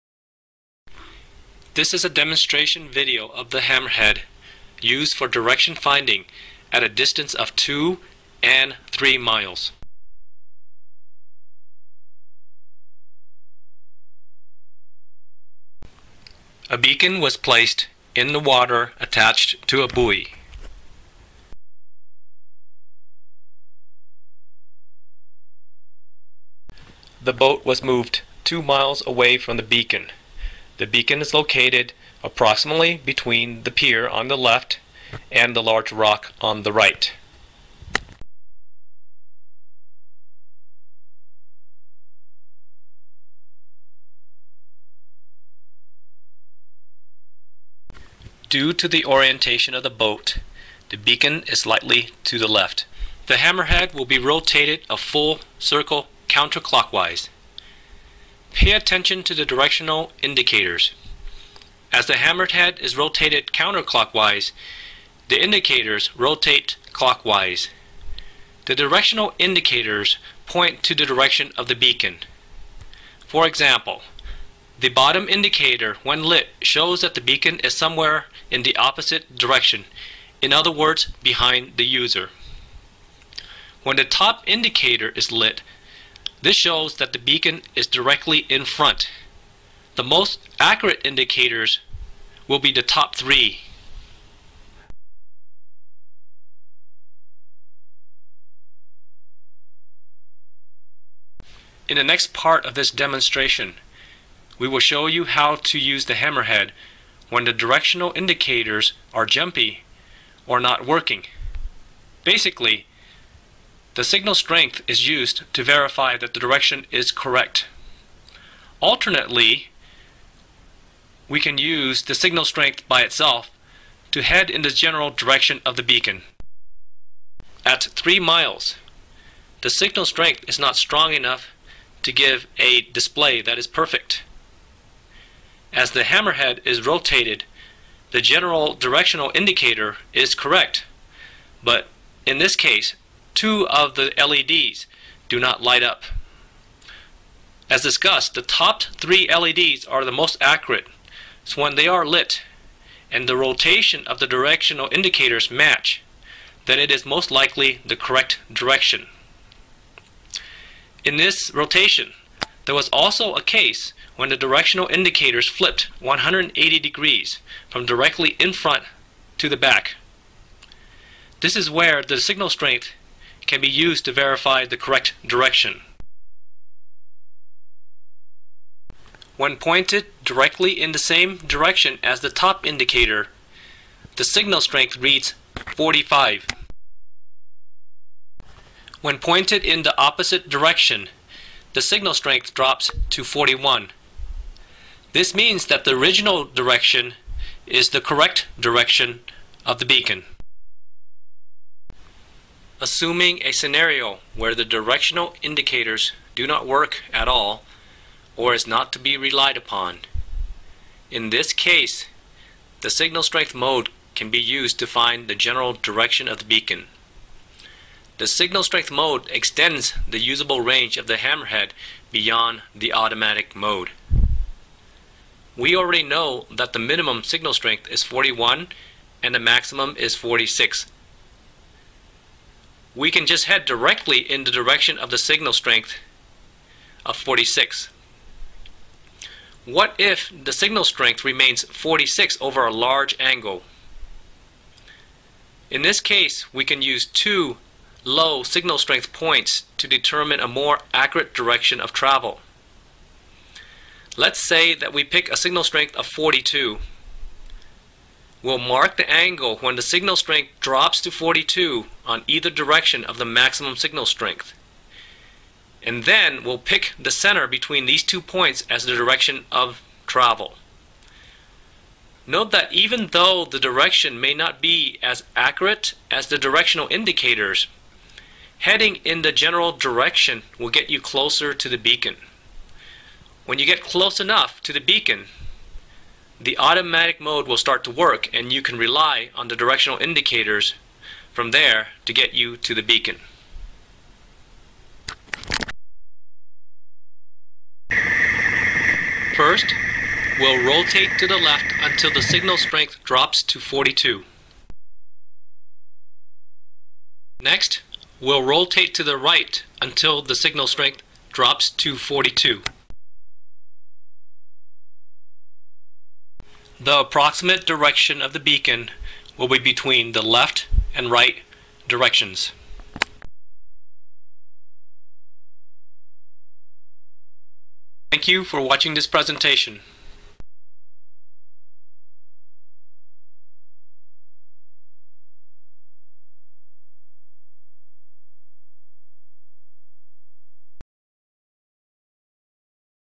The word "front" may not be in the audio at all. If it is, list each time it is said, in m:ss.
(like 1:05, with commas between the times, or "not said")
1:28, 2:48.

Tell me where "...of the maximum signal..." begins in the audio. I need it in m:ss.
4:23.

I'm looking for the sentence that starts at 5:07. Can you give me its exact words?
Next, we'll rotate to the right until the signal strength drops to 42.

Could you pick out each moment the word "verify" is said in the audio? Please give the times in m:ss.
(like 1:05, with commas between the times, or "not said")
1:55, 2:54.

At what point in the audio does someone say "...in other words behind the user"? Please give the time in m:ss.
1:20.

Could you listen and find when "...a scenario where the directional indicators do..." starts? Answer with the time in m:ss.
3:23.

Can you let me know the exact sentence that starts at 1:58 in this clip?
Alternately, we can use the signal strength by itself to head in the general direction of the beacon.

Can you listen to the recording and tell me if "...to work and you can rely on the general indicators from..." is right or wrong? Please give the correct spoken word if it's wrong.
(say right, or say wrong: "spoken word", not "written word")
wrong: "directional", not "general".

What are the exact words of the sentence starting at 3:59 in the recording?
What if the signal strength remains 46 over a large angle?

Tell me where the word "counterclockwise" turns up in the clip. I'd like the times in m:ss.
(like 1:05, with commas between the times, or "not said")
0:56, 1:03.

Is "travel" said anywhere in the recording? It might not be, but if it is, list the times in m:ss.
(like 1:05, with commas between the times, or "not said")
4:11, 4:30.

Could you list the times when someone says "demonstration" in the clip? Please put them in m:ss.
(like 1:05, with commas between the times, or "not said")
0:02, 1:42.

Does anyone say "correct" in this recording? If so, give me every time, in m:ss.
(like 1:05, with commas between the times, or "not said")
1:57, 2:20, 2:37, 2:54, 3:17.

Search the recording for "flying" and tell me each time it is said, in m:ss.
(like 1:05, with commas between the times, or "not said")
not said.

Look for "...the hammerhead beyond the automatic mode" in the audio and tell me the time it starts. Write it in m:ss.
3:41.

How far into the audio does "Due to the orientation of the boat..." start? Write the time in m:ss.
0:48.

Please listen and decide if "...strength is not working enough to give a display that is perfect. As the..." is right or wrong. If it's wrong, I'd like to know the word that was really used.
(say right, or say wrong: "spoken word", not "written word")
wrong: "strong", not "working".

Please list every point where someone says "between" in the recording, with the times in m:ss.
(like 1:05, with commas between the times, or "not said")
0:33, 4:27, 5:19.